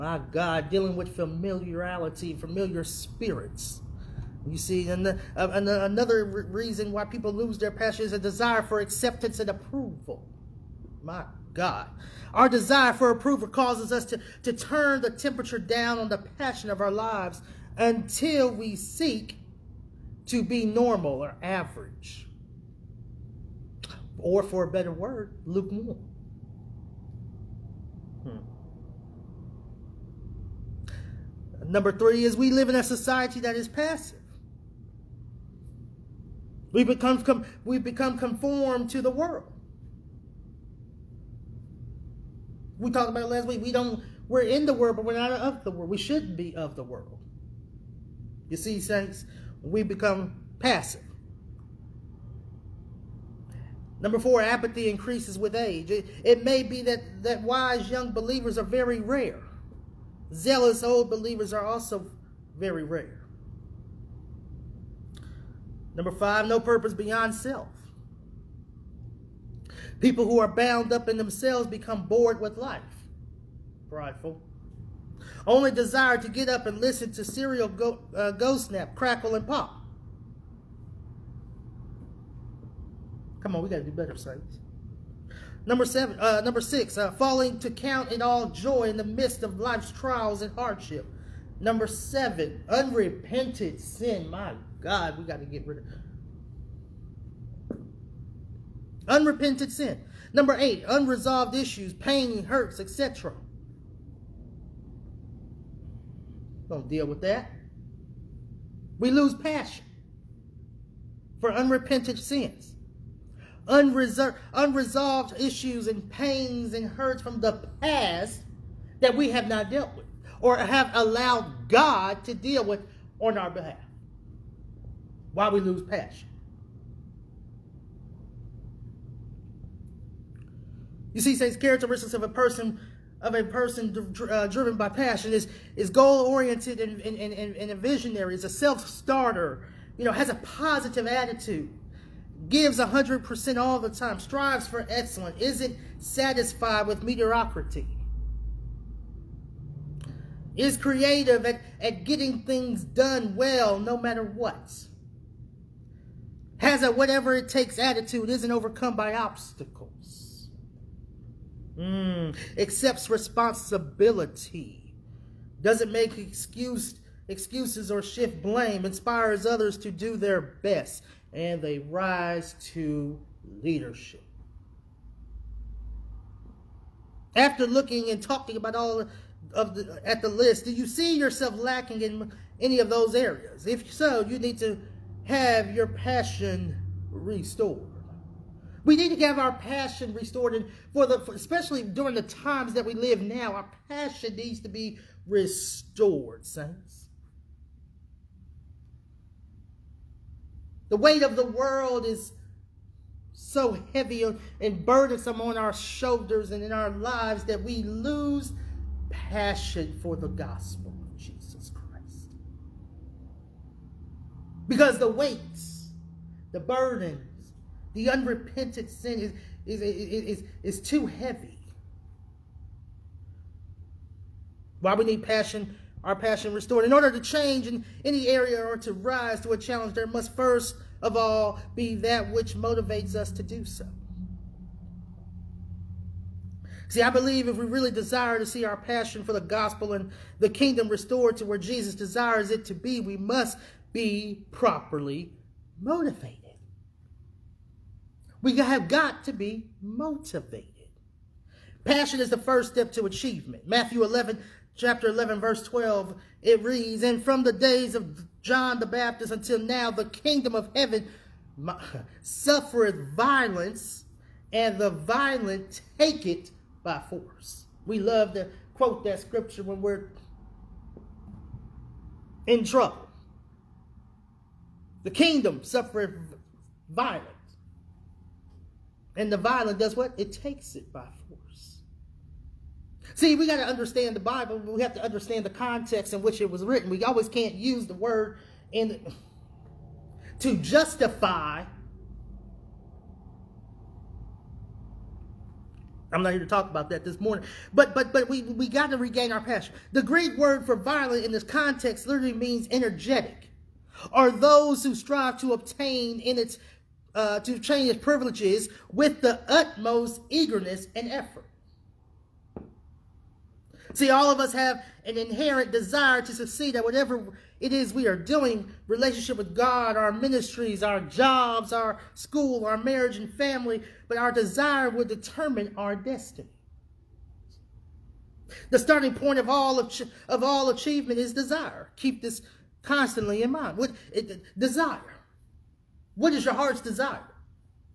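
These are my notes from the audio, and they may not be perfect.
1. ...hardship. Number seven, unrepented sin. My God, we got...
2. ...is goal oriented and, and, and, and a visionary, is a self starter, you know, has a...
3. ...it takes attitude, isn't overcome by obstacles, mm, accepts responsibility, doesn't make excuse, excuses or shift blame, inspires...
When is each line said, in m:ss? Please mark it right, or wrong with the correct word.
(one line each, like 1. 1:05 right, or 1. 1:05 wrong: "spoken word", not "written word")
1. 1:30 right
2. 2:15 right
3. 2:37 right.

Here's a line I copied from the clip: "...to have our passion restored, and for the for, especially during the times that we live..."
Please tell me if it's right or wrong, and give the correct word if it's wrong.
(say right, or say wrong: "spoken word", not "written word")
right.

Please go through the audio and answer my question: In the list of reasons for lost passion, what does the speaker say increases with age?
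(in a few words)
Apathy.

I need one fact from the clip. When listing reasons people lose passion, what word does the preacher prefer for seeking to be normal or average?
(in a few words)
Lukewarm.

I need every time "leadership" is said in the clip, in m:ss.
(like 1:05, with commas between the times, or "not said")
2:53.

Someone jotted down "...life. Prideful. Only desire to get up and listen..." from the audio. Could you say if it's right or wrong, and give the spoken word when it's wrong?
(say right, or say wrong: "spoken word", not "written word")
right.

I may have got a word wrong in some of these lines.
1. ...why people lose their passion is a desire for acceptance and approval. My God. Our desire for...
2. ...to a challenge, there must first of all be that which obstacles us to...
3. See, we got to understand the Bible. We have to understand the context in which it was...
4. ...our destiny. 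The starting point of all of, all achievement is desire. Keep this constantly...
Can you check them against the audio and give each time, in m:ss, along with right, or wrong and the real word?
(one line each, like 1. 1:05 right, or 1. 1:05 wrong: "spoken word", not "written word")
1. 0:06 right
2. 3:49 wrong: "motivates", not "obstacles"
3. 4:43 right
4. 5:25 right.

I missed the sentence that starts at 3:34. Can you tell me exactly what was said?
Because the weights, the burdens, the unrepented sin is, is, is, is, is too heavy.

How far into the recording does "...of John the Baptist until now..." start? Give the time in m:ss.
4:17.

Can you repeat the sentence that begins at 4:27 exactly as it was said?
We love to quote that scripture when we're in trouble.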